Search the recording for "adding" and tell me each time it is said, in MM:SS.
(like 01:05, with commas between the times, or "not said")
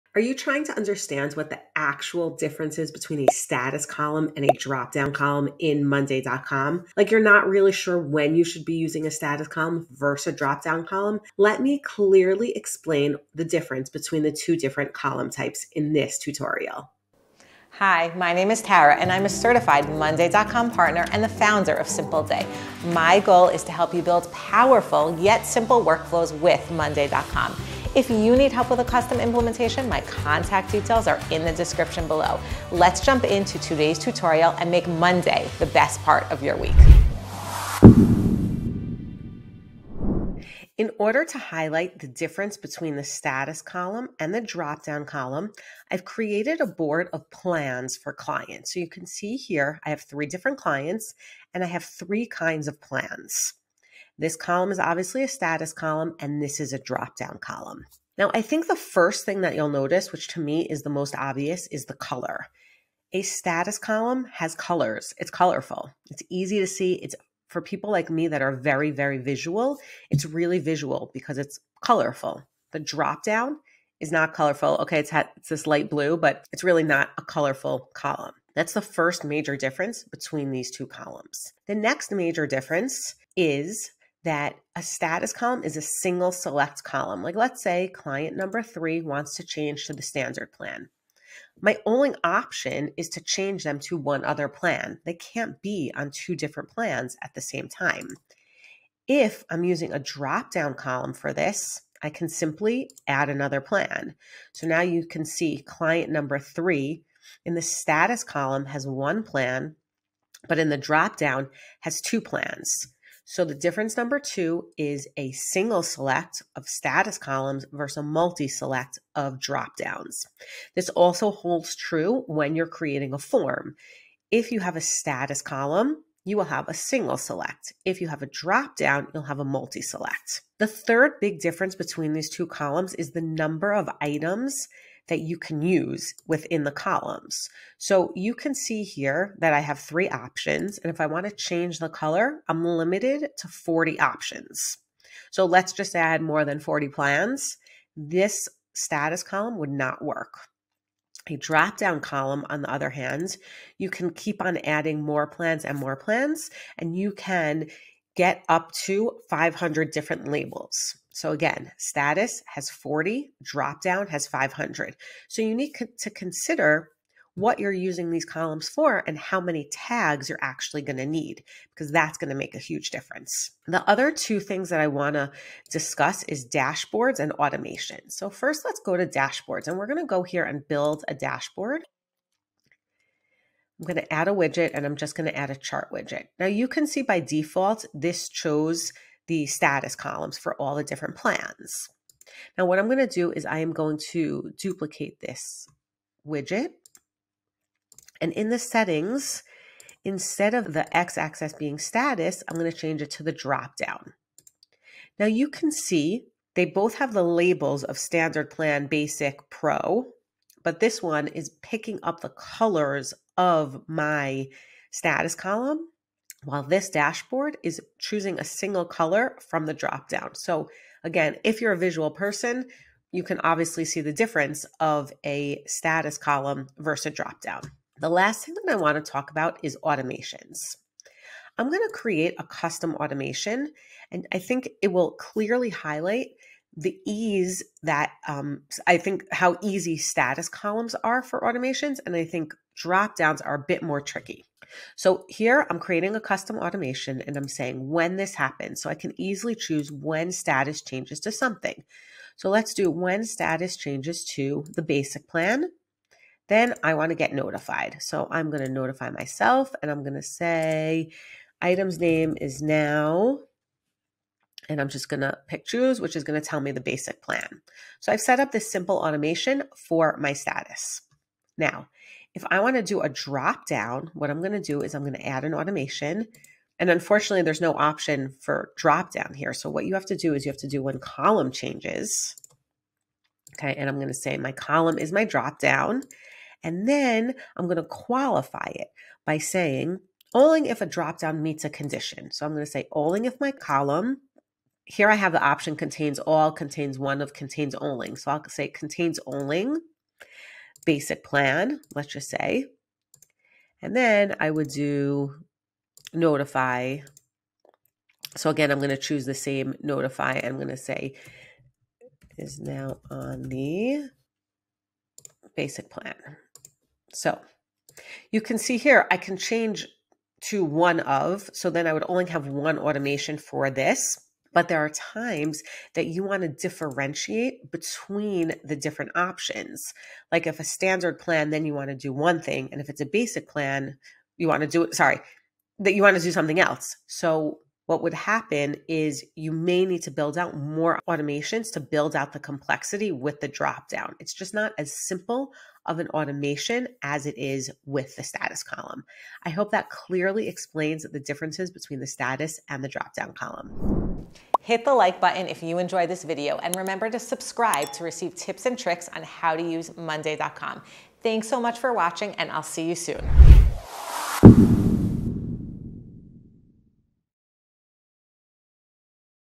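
02:34.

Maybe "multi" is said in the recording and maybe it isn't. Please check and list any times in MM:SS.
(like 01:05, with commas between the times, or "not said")
01:58, 02:09.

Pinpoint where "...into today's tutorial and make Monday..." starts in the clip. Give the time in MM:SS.
00:33.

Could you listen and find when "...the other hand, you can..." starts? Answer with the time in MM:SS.
02:32.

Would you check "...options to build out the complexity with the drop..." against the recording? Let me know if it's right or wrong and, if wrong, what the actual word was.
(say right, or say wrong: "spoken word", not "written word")
wrong: "automations", not "options".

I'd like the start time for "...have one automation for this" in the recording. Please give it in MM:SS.
05:22.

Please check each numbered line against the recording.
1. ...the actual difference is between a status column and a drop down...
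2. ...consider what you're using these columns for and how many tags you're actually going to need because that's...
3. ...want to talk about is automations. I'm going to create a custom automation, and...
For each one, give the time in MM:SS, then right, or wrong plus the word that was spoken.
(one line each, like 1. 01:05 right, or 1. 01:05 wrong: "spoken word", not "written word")
1. 00:01 right
2. 02:46 right
3. 03:48 right.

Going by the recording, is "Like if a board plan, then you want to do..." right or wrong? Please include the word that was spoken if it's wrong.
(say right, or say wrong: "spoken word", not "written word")
wrong: "standard", not "board".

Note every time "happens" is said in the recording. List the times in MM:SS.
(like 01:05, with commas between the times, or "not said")
04:08, 05:38.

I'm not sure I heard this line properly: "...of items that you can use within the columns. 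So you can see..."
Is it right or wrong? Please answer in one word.
right.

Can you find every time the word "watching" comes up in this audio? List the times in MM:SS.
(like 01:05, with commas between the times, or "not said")
06:01.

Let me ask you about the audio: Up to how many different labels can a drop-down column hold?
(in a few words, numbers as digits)
500.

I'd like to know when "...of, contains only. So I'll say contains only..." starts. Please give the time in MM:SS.
04:57.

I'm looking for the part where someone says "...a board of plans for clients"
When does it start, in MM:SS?
00:46.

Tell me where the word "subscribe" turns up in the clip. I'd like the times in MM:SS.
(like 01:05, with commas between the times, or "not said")
05:57.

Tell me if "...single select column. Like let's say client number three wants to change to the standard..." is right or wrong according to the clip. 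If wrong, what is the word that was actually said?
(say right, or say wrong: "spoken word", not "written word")
right.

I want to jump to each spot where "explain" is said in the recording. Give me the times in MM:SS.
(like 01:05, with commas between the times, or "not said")
00:12, 05:50.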